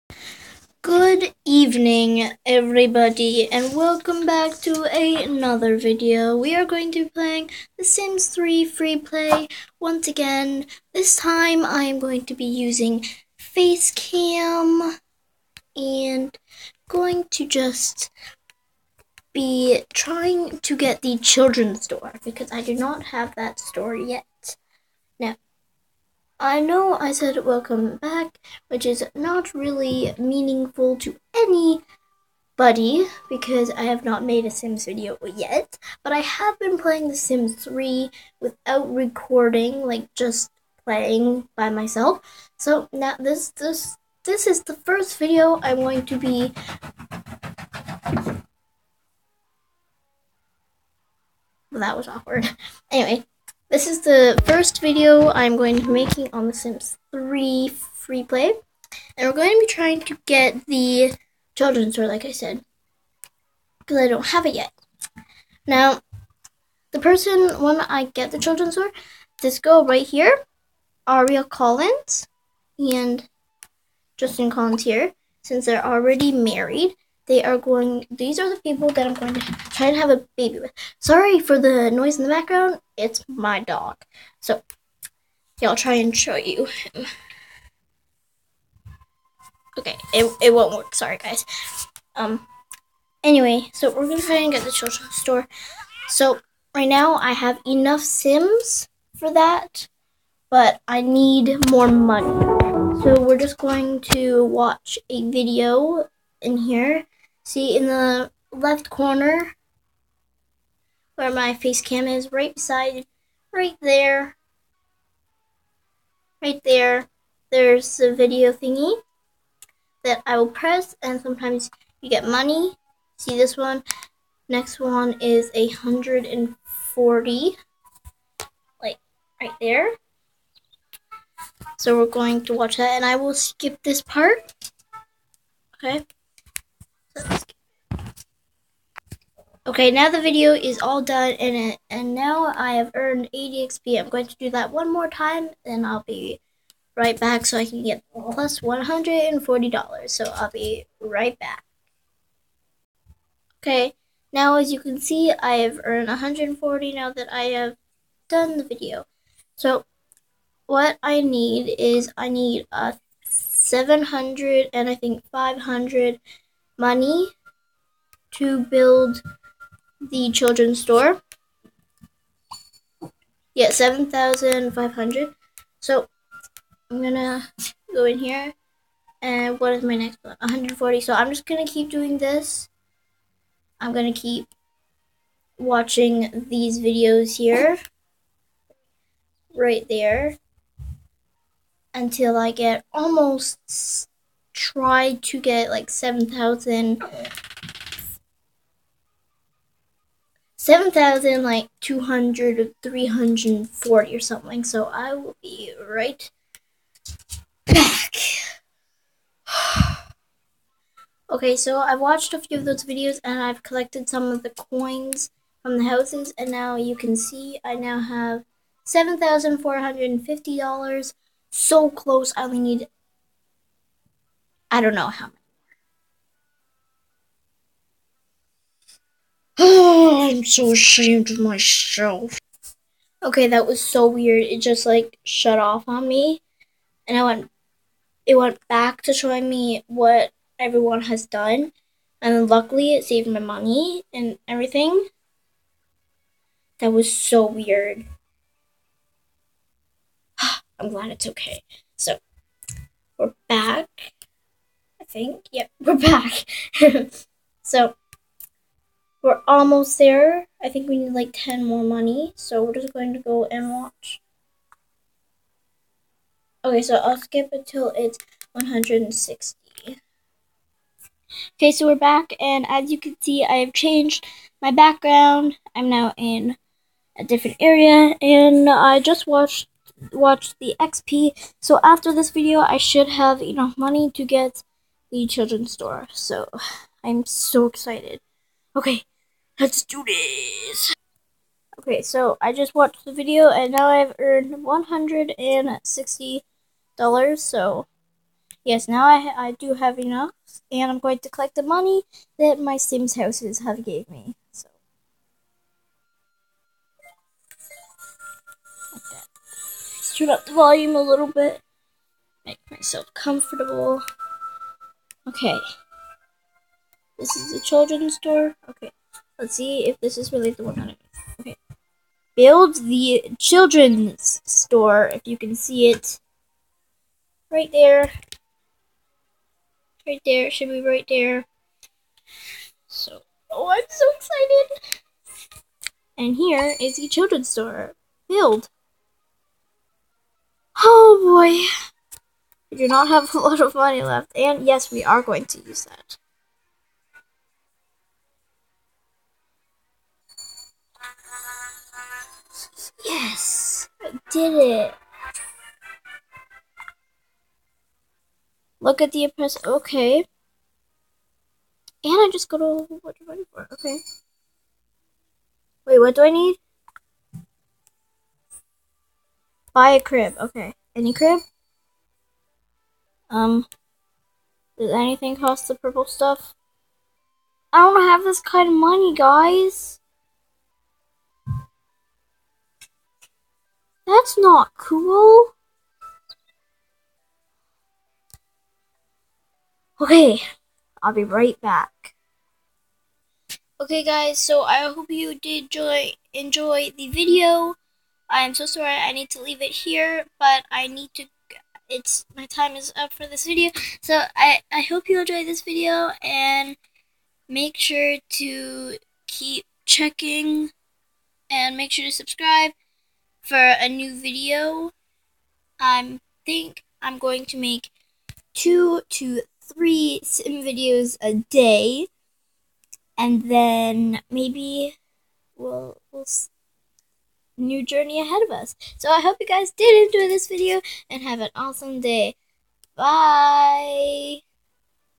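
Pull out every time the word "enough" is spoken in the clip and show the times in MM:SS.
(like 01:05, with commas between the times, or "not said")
01:37, 04:43, 04:59.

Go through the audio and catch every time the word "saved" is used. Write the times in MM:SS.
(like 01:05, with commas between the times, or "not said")
04:03.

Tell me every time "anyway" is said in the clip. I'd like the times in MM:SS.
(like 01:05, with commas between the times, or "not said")
00:52, 01:33.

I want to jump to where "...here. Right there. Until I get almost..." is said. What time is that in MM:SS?
03:07.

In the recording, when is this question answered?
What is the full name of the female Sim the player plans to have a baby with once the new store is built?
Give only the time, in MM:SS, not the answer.
01:11.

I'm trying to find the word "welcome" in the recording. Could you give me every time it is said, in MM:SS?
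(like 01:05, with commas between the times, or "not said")
00:03, 00:27.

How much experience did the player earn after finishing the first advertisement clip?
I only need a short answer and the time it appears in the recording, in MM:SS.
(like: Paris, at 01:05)
80 XP, at 02:23.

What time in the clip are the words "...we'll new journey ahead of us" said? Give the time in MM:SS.
07:06.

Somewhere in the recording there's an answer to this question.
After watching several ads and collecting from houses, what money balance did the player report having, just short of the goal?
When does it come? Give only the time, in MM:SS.
03:38.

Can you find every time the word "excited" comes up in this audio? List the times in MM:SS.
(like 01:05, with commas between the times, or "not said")
04:47, 05:34.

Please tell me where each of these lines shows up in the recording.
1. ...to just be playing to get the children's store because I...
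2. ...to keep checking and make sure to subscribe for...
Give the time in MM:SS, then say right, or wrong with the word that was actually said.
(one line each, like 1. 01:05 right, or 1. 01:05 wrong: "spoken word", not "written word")
1. 00:17 wrong: "trying", not "playing"
2. 06:48 right.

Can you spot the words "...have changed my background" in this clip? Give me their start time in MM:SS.
04:33.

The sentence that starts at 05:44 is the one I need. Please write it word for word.
And yes, we are going to use that.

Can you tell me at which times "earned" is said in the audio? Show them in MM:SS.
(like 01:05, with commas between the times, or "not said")
02:22, 02:35, 04:54.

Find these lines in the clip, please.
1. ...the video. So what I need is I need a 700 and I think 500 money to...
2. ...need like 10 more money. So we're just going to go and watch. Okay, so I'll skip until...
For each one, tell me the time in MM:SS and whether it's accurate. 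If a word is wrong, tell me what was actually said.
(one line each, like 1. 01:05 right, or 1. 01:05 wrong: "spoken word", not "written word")
1. 02:38 right
2. 04:20 right.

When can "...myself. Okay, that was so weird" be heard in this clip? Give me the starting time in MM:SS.
03:51.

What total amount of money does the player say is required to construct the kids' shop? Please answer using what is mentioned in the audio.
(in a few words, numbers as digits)
7,500.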